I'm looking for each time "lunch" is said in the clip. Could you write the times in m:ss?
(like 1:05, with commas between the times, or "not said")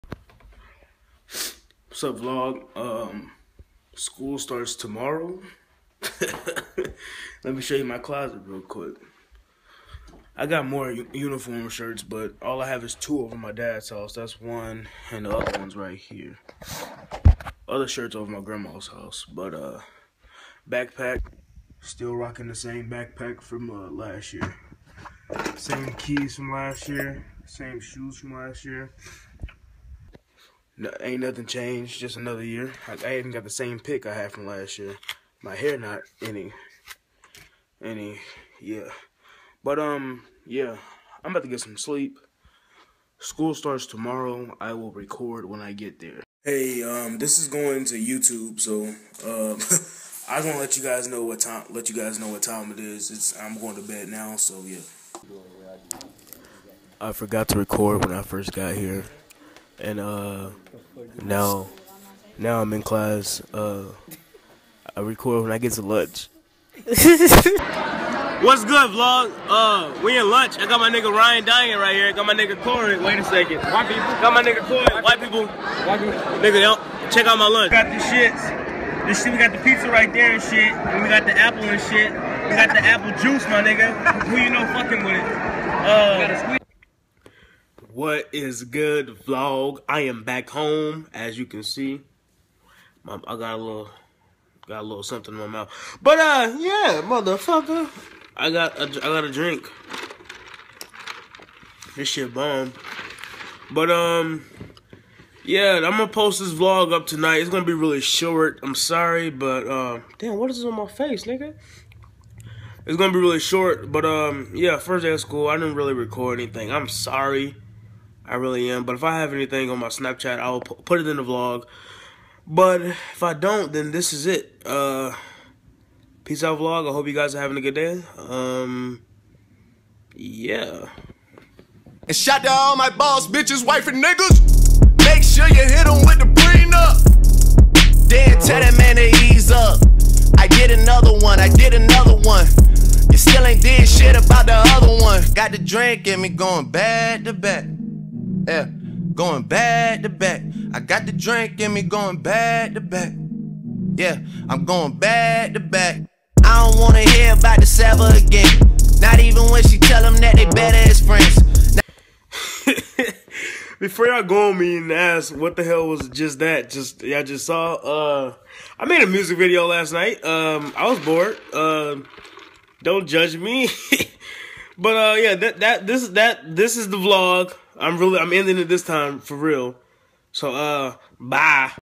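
1:05, 1:10, 1:17.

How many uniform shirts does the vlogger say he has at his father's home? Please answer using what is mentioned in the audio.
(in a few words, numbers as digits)
2.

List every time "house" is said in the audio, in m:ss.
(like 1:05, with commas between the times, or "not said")
0:13, 0:18.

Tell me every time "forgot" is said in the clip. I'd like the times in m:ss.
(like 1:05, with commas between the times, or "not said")
0:57.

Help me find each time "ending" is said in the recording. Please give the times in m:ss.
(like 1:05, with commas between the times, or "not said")
2:58.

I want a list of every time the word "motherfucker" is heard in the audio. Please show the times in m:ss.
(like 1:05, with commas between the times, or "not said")
1:37.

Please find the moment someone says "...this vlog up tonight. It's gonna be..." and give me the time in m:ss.
1:46.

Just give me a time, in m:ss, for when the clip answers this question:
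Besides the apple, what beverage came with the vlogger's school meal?
1:22.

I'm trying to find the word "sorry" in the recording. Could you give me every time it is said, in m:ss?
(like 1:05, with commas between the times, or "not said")
1:48, 1:56.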